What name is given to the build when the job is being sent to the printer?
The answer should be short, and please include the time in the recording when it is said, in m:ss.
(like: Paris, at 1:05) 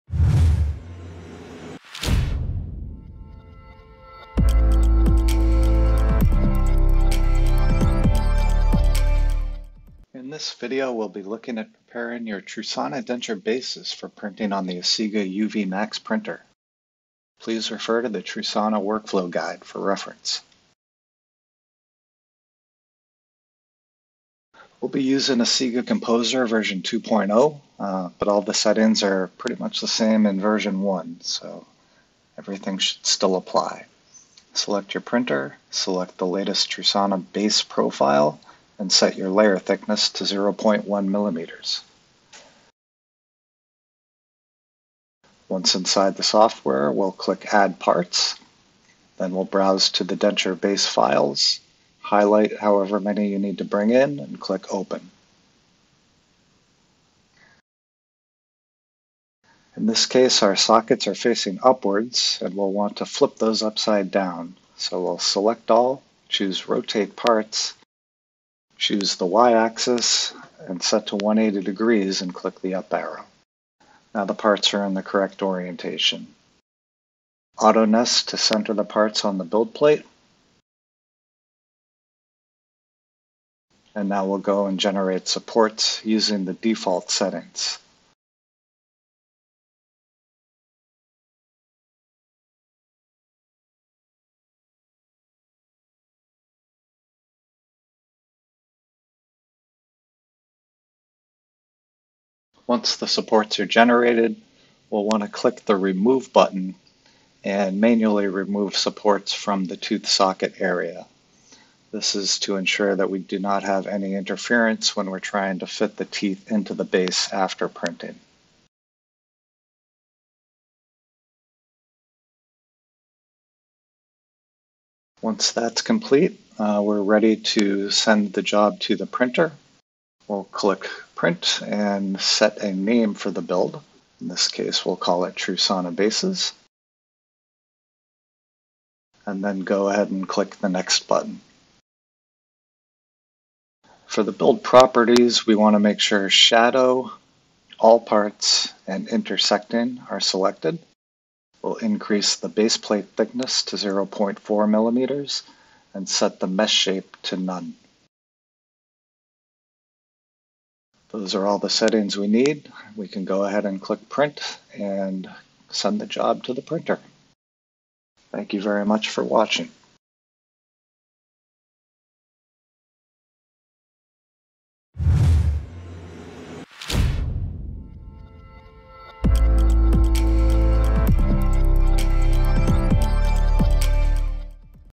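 Trusana Bases, at 2:15.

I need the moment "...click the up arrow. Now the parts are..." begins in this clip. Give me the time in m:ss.
1:12.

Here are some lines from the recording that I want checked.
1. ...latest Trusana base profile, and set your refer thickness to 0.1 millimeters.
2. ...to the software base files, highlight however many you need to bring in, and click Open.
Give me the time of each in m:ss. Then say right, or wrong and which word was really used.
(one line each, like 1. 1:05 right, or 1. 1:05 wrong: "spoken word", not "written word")
1. 0:36 wrong: "layer", not "refer"
2. 0:49 wrong: "denture", not "software".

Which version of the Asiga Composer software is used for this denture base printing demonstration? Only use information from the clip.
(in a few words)
2.0.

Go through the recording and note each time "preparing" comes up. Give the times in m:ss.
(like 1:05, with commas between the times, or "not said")
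0:11.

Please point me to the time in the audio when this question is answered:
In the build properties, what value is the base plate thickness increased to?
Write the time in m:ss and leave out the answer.
2:33.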